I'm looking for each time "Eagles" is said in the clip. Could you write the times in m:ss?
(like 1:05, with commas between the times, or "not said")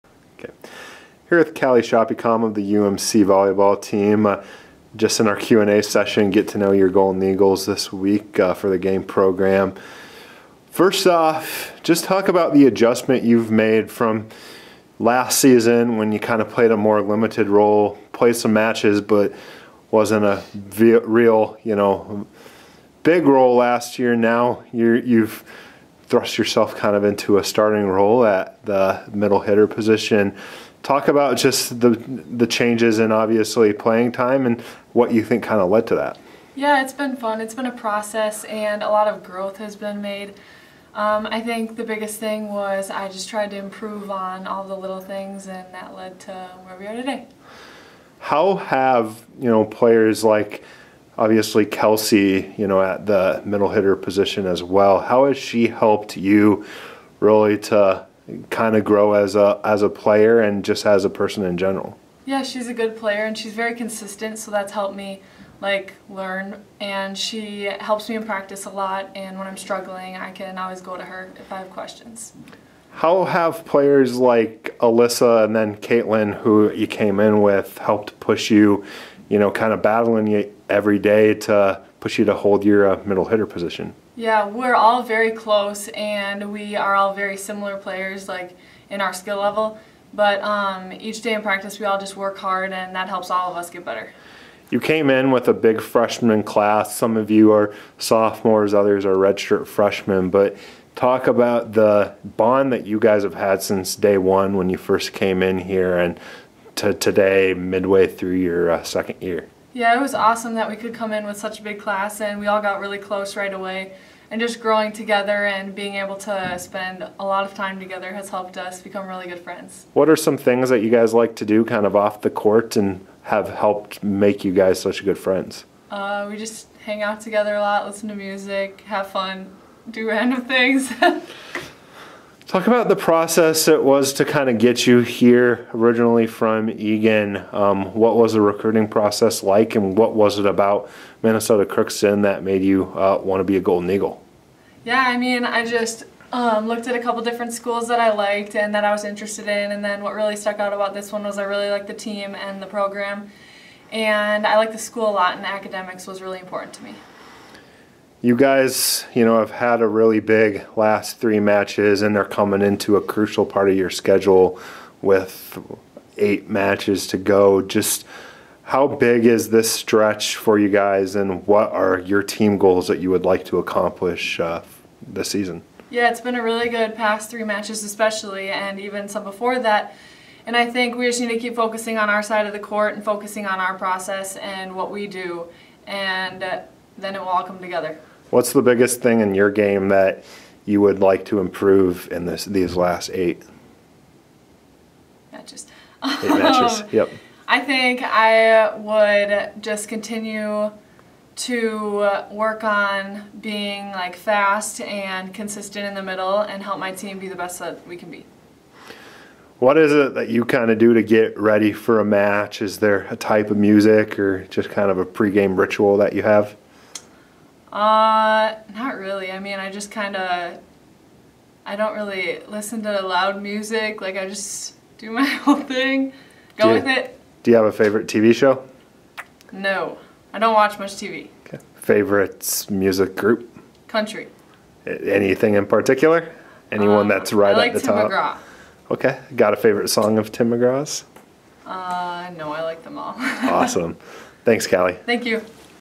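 0:07, 2:23.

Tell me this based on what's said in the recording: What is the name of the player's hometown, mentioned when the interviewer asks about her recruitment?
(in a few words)
Egan.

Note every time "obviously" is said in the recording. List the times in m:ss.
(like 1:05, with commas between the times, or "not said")
0:33, 0:51.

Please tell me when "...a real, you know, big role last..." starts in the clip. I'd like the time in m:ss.
0:20.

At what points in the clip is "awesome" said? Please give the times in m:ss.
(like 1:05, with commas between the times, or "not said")
1:50, 4:03.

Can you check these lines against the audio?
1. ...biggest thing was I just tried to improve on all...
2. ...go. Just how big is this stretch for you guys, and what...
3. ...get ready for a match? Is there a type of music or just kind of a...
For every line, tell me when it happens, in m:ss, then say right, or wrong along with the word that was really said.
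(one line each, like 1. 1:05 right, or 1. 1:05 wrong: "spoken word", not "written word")
1. 0:41 right
2. 2:47 right
3. 3:31 right.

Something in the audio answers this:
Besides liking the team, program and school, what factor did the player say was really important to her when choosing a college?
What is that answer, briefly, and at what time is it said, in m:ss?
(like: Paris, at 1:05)
Academics, at 2:35.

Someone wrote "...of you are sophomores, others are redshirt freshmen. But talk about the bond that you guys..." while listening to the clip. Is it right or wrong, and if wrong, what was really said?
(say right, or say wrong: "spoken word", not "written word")
right.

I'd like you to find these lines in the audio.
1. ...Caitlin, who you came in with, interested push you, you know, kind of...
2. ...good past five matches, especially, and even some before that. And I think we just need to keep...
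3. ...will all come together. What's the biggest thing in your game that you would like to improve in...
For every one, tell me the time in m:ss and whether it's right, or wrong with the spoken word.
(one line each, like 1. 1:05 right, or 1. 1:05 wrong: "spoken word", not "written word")
1. 1:15 wrong: "helped", not "interested"
2. 2:56 wrong: "three", not "five"
3. 3:07 right.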